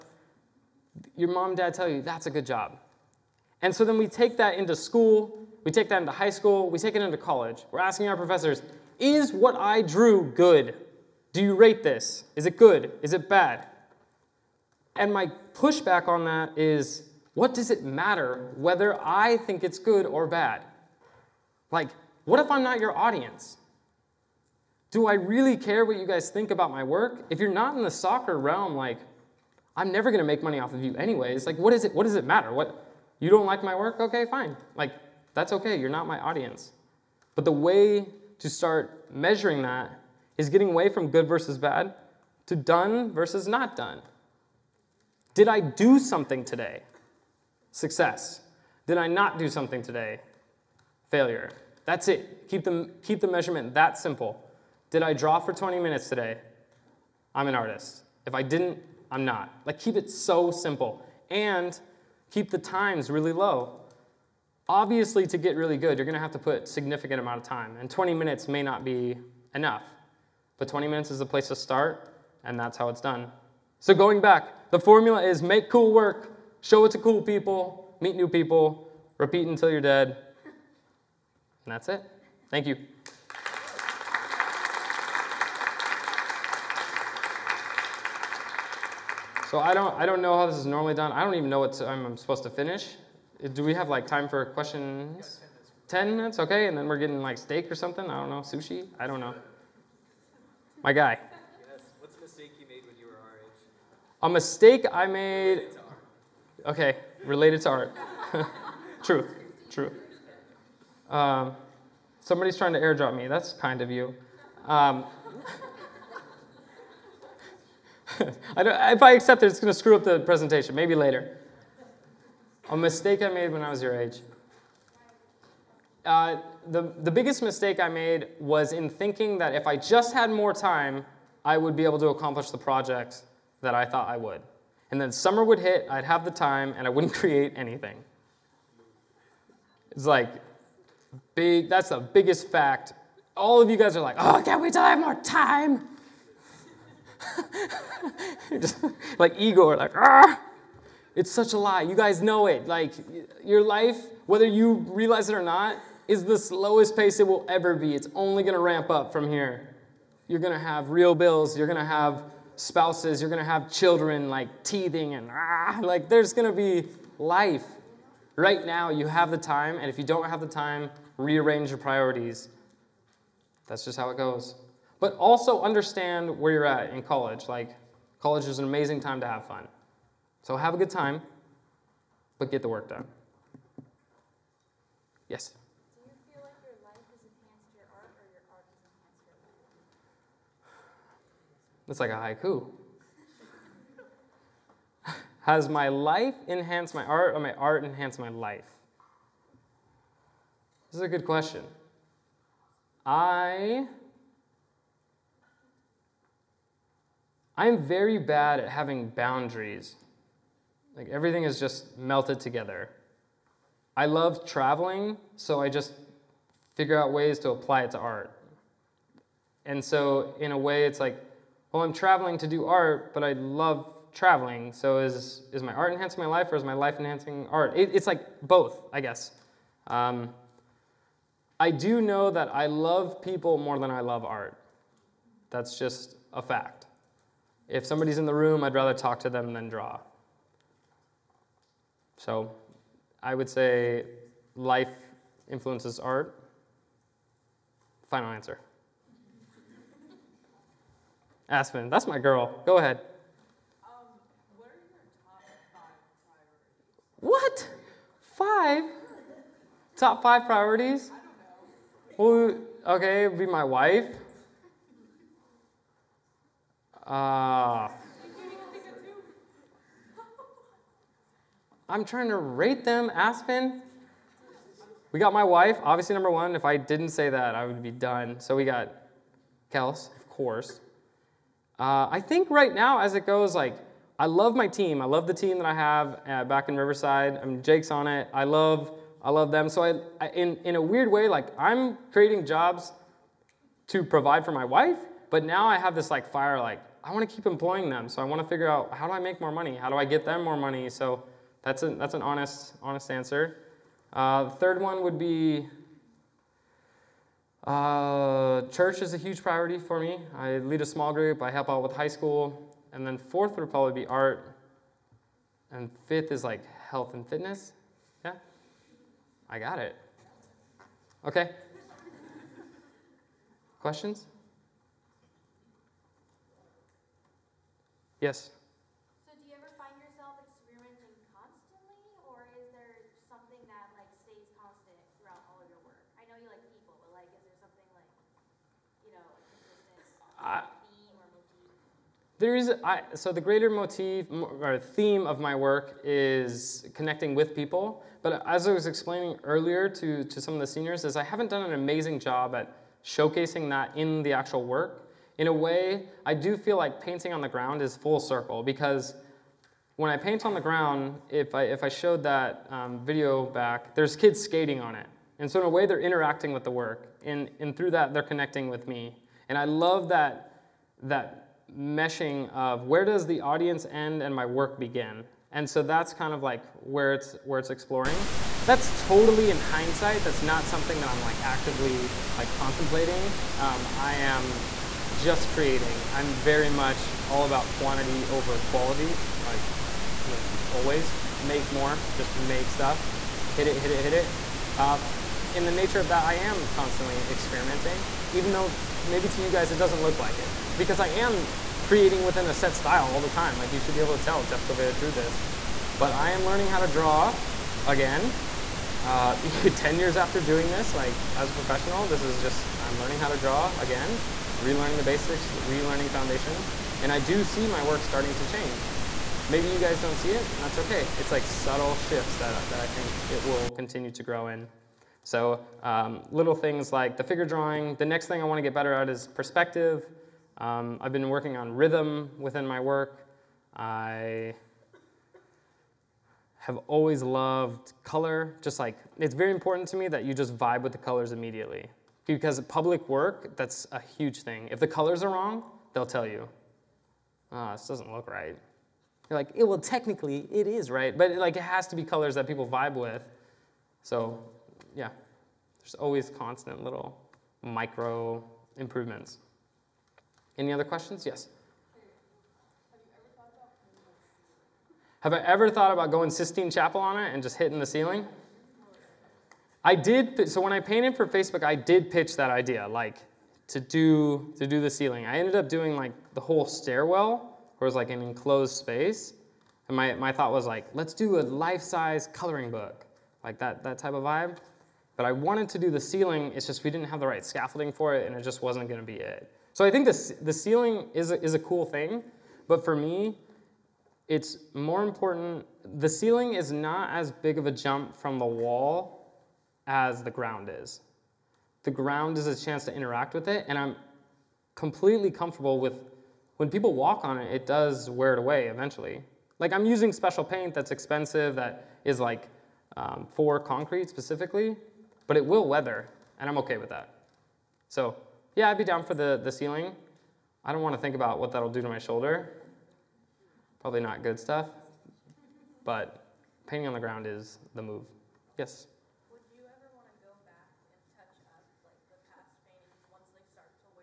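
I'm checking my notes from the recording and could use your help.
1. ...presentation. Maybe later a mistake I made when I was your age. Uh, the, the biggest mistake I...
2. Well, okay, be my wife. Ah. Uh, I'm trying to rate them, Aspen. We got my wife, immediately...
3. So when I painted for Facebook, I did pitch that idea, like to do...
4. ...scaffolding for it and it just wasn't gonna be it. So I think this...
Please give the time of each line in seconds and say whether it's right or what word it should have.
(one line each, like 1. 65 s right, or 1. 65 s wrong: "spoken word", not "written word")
1. 120 s right
2. 262 s wrong: "obviously", not "immediately"
3. 470 s right
4. 487 s right.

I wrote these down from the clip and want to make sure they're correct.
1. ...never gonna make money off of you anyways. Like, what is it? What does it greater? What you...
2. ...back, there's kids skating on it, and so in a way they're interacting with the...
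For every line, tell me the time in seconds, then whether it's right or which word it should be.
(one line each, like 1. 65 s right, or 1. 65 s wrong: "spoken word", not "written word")
1. 29 s wrong: "matter", not "greater"
2. 363 s right.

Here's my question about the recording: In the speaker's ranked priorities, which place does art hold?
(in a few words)
fourth.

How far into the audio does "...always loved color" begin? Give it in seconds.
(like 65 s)
436 s.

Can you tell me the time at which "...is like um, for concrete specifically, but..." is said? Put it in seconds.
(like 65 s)
512 s.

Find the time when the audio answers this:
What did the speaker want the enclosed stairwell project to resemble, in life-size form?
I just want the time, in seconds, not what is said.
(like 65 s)
482 s.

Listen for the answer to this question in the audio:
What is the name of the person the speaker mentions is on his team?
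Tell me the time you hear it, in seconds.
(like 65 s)
287 s.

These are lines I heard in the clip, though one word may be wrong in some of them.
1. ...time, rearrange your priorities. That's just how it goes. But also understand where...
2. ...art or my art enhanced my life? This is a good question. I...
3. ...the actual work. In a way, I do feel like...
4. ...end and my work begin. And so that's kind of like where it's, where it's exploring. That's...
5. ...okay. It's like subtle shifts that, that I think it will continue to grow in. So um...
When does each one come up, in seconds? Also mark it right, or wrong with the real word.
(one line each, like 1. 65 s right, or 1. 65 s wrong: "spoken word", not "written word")
1. 170 s right
2. 197 s right
3. 354 s right
4. 373 s right
5. 420 s right.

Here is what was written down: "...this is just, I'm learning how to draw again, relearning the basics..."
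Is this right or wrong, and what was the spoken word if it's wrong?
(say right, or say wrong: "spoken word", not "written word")
right.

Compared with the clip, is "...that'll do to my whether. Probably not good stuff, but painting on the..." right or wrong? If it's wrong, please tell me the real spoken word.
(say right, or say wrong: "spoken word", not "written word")
wrong: "shoulder", not "whether".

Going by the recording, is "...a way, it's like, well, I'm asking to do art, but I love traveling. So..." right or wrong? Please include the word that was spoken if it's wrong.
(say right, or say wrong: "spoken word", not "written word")
wrong: "traveling", not "asking".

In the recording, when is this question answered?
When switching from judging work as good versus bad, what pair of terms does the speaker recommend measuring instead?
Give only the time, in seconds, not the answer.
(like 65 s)
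42 s.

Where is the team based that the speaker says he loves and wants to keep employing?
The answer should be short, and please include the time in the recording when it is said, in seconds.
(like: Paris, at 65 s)
Riverside, at 286 s.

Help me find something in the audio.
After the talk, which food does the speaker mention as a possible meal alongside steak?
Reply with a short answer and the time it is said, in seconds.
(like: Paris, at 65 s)
sushi, at 98 s.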